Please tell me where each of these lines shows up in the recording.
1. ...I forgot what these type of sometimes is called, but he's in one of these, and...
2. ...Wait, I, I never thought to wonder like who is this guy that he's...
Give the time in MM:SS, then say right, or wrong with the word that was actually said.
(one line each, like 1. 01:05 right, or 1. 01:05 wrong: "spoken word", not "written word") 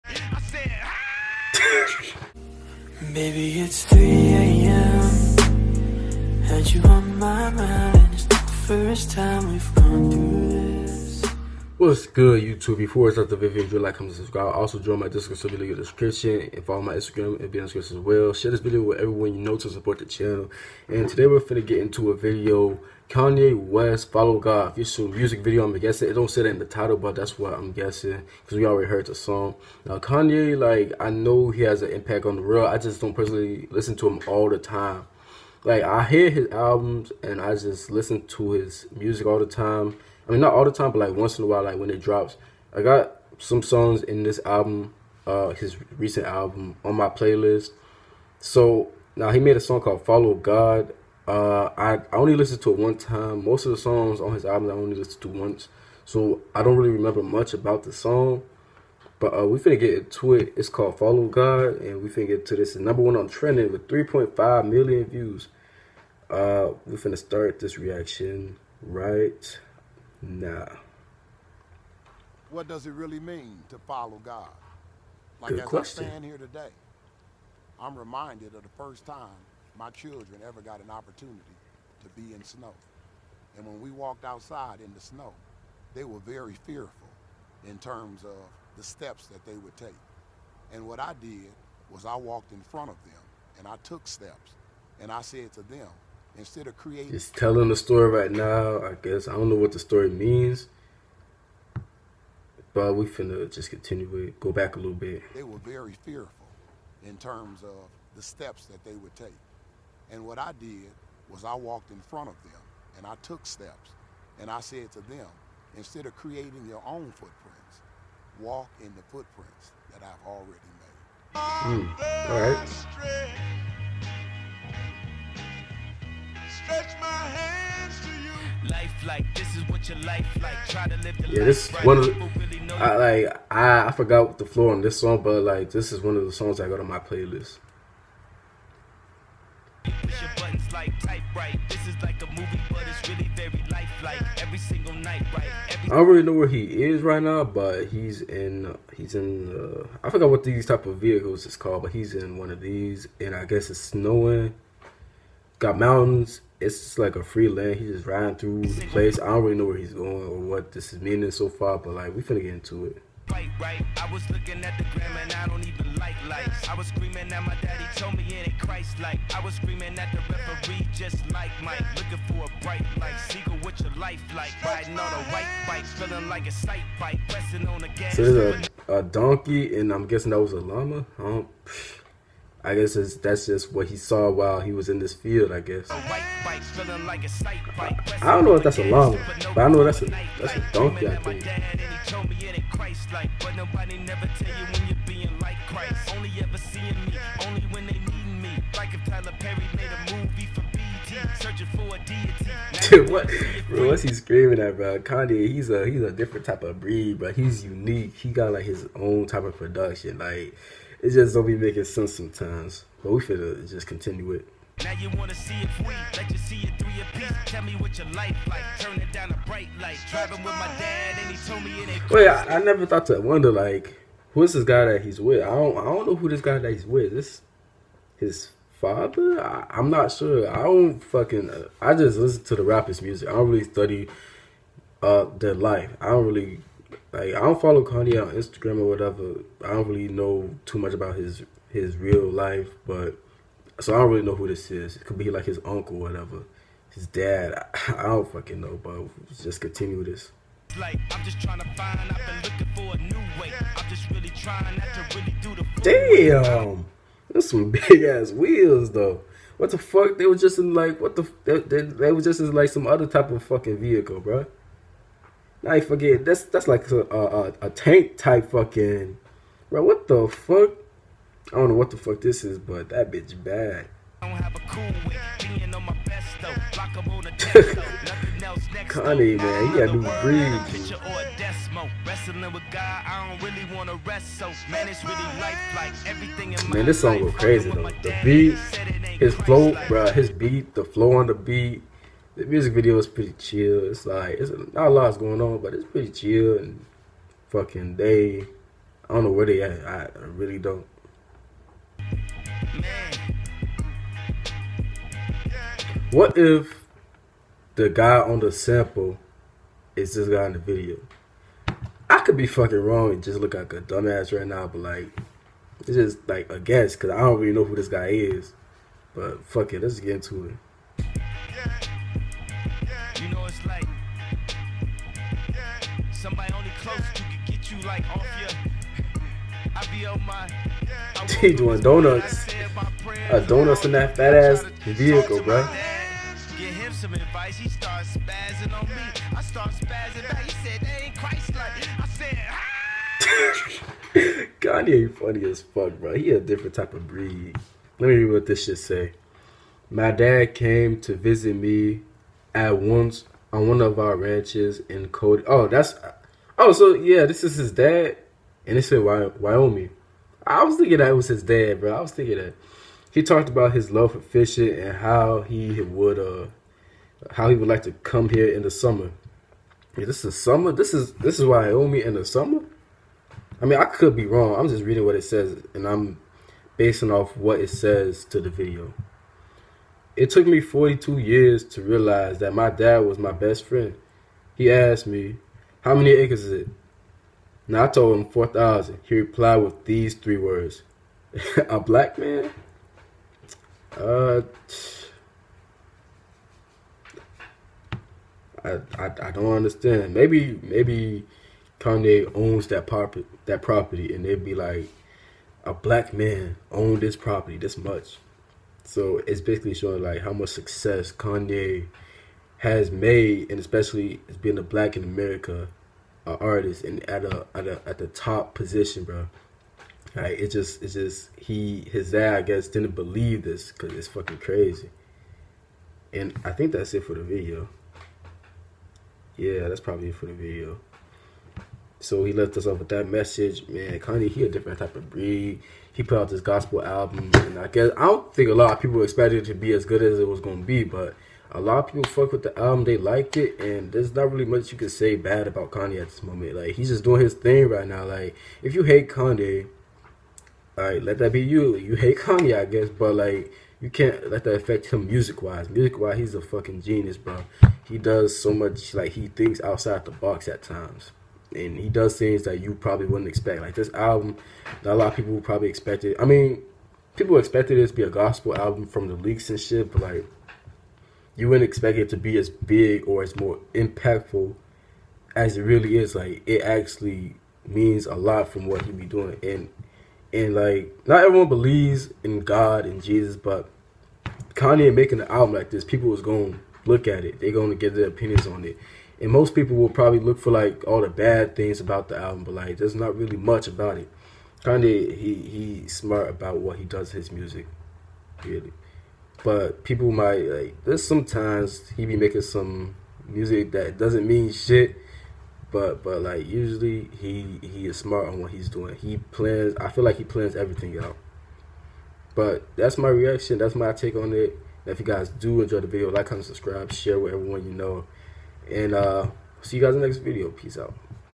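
1. 02:30 wrong: "vehicles", not "sometimes"
2. 03:42 right.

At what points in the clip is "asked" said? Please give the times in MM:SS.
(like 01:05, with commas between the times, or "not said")
06:24.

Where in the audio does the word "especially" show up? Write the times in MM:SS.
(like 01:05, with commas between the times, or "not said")
06:53.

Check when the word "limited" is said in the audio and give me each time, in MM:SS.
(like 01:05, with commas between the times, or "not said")
not said.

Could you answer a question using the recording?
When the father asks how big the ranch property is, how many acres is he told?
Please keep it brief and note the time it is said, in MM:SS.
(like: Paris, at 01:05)
4,000, at 06:28.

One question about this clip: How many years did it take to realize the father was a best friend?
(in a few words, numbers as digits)
42.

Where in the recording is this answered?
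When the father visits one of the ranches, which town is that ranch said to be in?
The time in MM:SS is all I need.
05:55.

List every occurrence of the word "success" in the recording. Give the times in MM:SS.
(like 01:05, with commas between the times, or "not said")
06:50.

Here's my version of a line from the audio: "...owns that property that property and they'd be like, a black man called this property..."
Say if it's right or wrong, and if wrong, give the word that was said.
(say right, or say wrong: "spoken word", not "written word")
wrong: "owned", not "called".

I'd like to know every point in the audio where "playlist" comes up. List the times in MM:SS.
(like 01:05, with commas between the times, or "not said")
00:47, 02:16.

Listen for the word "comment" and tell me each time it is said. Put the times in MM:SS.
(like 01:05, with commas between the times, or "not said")
00:13, 08:36.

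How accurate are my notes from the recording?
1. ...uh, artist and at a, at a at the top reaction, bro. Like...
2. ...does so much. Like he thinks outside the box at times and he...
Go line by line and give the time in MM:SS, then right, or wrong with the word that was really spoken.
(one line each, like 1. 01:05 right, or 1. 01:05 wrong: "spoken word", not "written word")
1. 06:56 wrong: "position", not "reaction"
2. 07:37 right.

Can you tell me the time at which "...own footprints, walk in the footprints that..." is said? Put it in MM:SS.
01:56.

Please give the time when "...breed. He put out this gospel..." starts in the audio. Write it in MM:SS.
07:15.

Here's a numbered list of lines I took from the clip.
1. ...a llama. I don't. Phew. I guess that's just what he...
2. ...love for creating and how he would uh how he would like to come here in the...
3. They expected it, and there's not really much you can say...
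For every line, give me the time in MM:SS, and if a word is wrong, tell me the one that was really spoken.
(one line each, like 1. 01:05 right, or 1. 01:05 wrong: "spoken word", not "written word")
1. 03:00 right
2. 06:03 wrong: "fishing", not "creating"
3. 07:22 wrong: "liked", not "expected".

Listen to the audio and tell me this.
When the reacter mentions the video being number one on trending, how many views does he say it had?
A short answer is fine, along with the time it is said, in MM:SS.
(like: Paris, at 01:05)
3.5 million, at 01:03.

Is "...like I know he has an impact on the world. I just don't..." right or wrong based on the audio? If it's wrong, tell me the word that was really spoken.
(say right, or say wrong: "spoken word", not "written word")
right.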